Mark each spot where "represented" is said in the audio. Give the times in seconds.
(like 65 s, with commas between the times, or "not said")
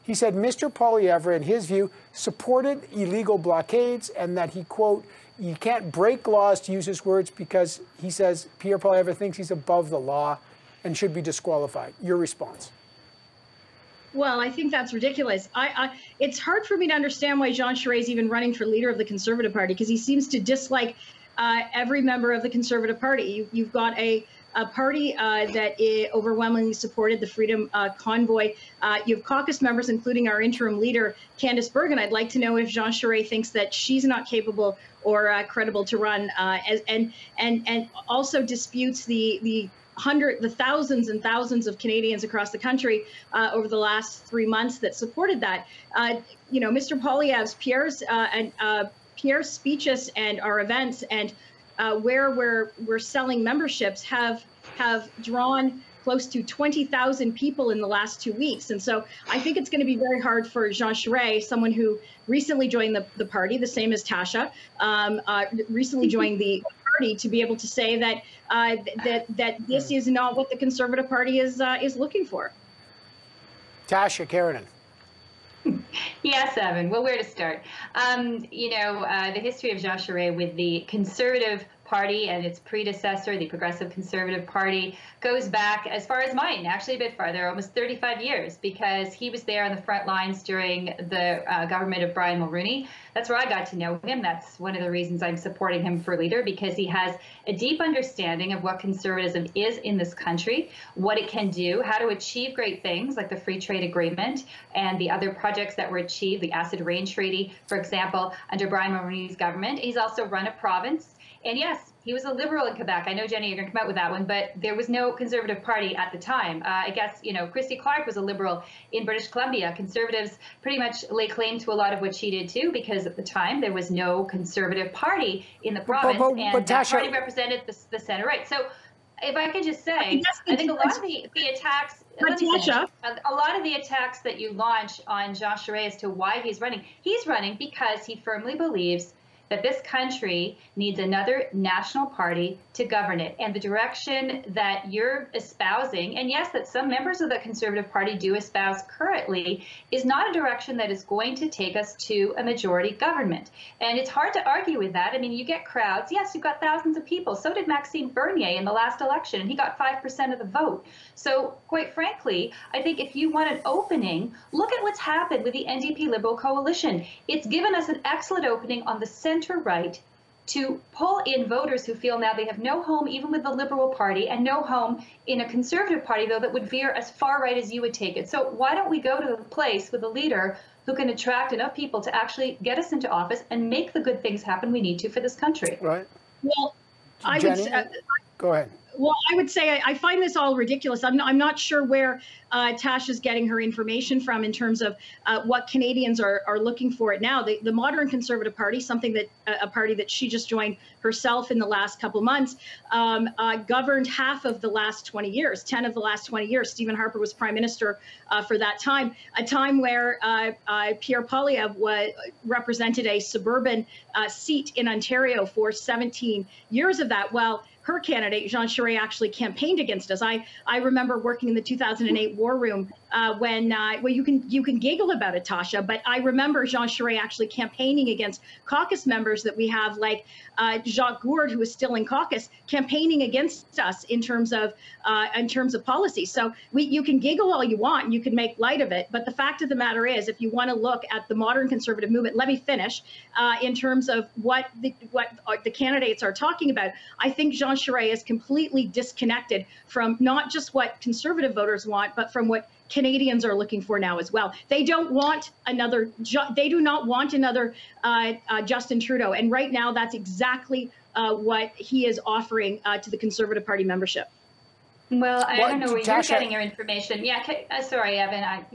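127 s, 212 s.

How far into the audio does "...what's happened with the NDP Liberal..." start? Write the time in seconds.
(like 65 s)
164 s.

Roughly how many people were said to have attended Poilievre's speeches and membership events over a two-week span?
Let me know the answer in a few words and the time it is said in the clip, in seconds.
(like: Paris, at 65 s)
20,000, at 56 s.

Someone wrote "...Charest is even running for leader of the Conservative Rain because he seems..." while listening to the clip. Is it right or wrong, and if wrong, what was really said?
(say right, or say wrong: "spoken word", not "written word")
wrong: "Party", not "Rain".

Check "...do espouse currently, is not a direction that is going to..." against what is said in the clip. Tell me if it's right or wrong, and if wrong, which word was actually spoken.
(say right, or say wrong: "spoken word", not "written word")
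right.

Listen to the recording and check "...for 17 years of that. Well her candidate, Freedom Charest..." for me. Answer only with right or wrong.
wrong.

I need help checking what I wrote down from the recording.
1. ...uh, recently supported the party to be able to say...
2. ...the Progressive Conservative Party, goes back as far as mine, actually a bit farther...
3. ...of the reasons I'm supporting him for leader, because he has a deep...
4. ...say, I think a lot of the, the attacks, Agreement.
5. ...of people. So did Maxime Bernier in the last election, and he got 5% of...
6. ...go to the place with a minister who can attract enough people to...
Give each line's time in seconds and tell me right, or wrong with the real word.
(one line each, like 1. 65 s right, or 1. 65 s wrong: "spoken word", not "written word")
1. 65 s wrong: "joined", not "supported"
2. 83 s right
3. 94 s right
4. 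129 s wrong: "Natasha", not "Agreement"
5. 156 s right
6. 178 s wrong: "leader", not "minister".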